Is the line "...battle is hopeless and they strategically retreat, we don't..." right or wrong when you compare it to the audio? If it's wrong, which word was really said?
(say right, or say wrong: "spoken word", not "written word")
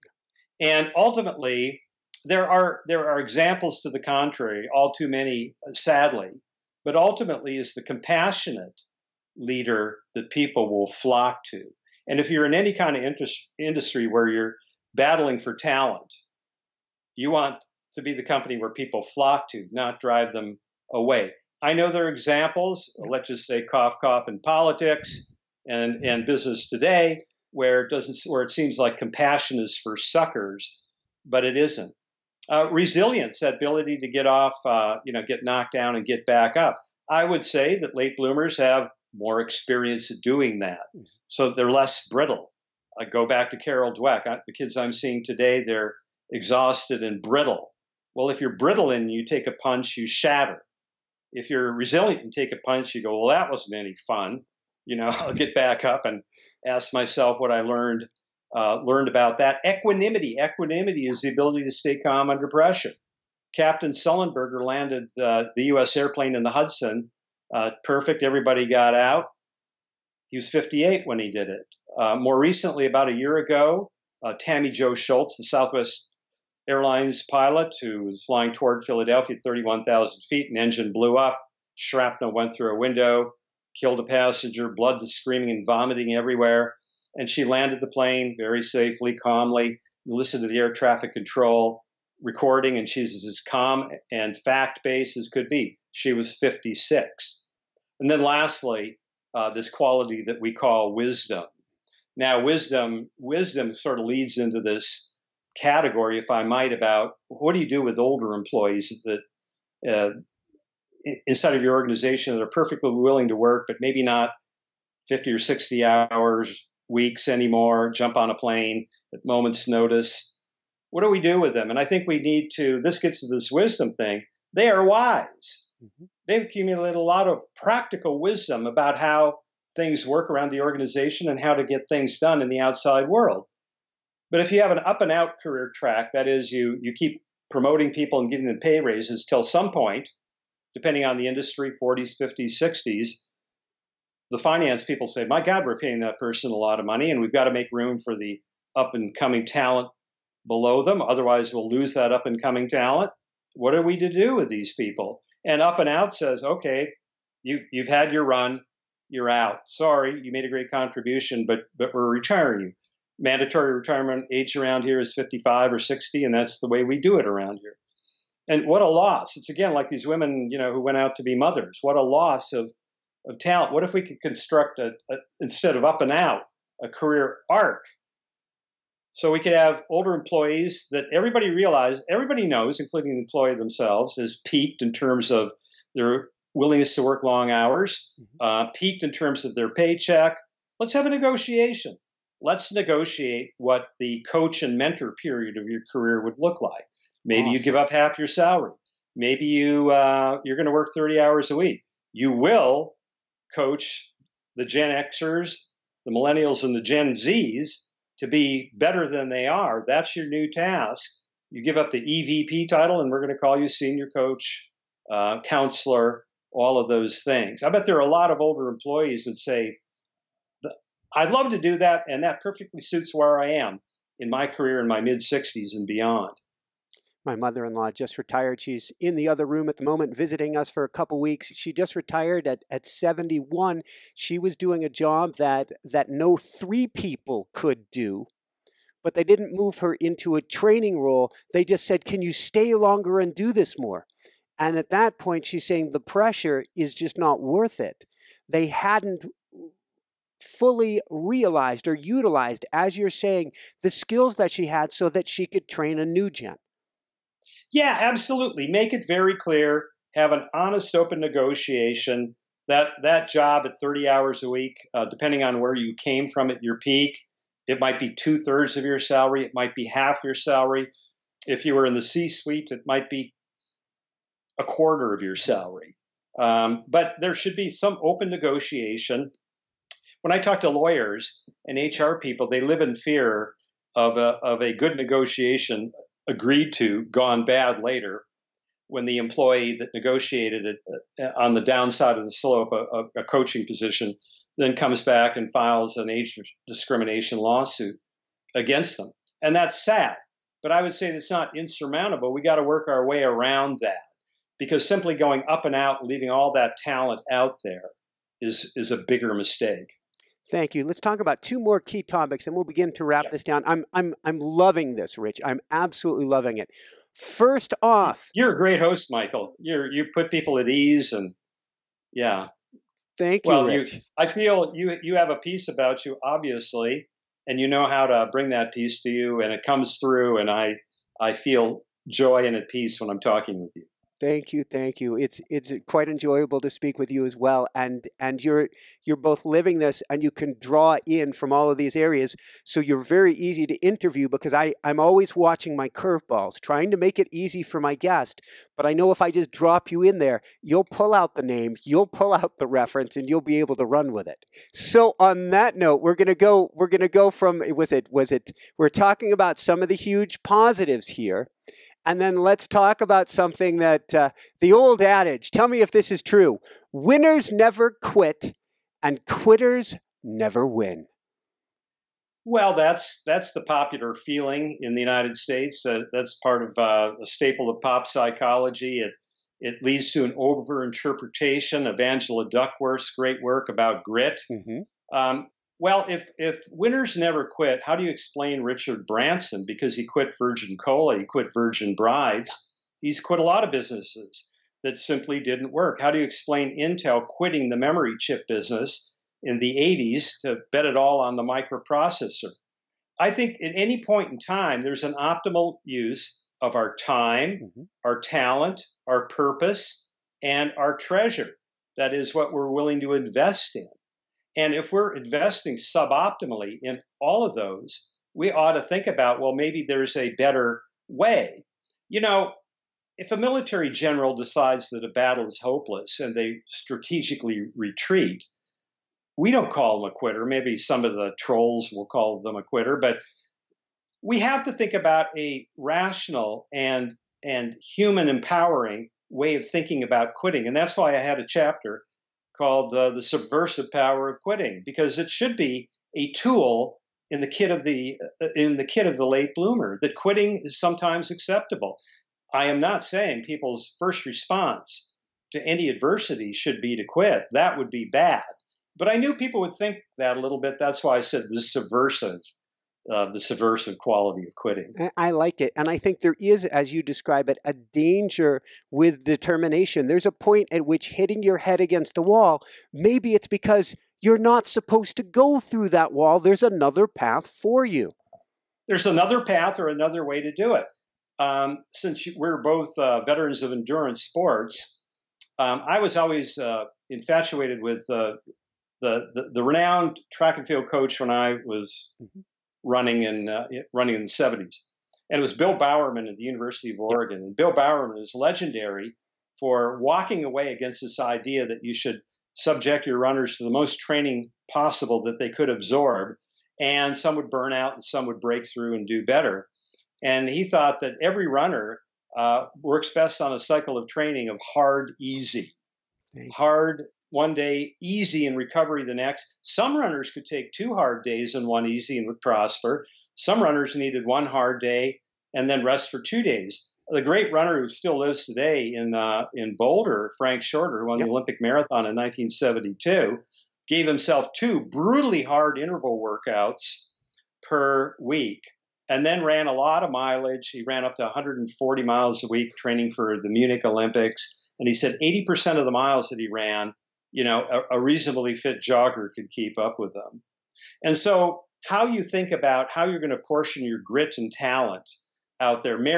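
right.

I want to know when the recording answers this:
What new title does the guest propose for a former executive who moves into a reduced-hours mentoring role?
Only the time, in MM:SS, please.
03:33.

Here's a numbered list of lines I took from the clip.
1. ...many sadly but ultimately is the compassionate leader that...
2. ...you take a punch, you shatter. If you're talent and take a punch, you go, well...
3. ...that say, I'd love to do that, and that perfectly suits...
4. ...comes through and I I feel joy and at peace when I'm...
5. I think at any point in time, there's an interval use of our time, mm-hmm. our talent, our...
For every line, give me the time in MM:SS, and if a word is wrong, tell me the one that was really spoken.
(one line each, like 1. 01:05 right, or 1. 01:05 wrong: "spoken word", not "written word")
1. 00:05 right
2. 00:49 wrong: "resilient", not "talent"
3. 03:39 right
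4. 05:29 right
5. 06:43 wrong: "optimal", not "interval".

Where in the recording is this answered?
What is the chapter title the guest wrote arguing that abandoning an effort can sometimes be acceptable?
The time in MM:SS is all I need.
07:23.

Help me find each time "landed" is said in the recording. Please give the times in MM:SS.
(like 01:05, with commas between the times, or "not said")
01:04, 01:27.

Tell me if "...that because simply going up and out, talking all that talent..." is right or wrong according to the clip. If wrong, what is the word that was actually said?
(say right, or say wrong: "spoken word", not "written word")
wrong: "leaving", not "talking".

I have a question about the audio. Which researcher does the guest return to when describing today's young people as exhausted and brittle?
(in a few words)
Carol Dweck.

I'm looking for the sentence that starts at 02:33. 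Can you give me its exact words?
What are we to do with these people?" And up and out says, "Okay, you've you've had your run." You're out.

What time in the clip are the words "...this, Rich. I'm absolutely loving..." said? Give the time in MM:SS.
05:14.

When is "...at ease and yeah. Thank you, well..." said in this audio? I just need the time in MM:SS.
05:20.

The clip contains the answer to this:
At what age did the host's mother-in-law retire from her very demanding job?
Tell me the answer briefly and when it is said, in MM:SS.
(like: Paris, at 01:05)
71, at 03:52.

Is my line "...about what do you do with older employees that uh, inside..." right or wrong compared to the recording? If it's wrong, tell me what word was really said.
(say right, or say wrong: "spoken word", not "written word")
right.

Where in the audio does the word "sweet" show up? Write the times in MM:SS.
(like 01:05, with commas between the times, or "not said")
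not said.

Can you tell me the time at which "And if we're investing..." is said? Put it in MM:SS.
06:54.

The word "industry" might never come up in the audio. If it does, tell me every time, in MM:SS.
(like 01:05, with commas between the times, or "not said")
00:13, 02:21.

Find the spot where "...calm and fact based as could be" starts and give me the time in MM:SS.
01:33.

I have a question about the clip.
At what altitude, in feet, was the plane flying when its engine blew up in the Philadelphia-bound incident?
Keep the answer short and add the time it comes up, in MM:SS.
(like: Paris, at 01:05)
31,000, at 01:19.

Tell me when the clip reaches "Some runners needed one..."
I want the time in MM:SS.
08:43.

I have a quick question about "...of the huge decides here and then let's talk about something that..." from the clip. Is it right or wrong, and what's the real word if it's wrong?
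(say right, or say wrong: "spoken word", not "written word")
wrong: "positives", not "decides".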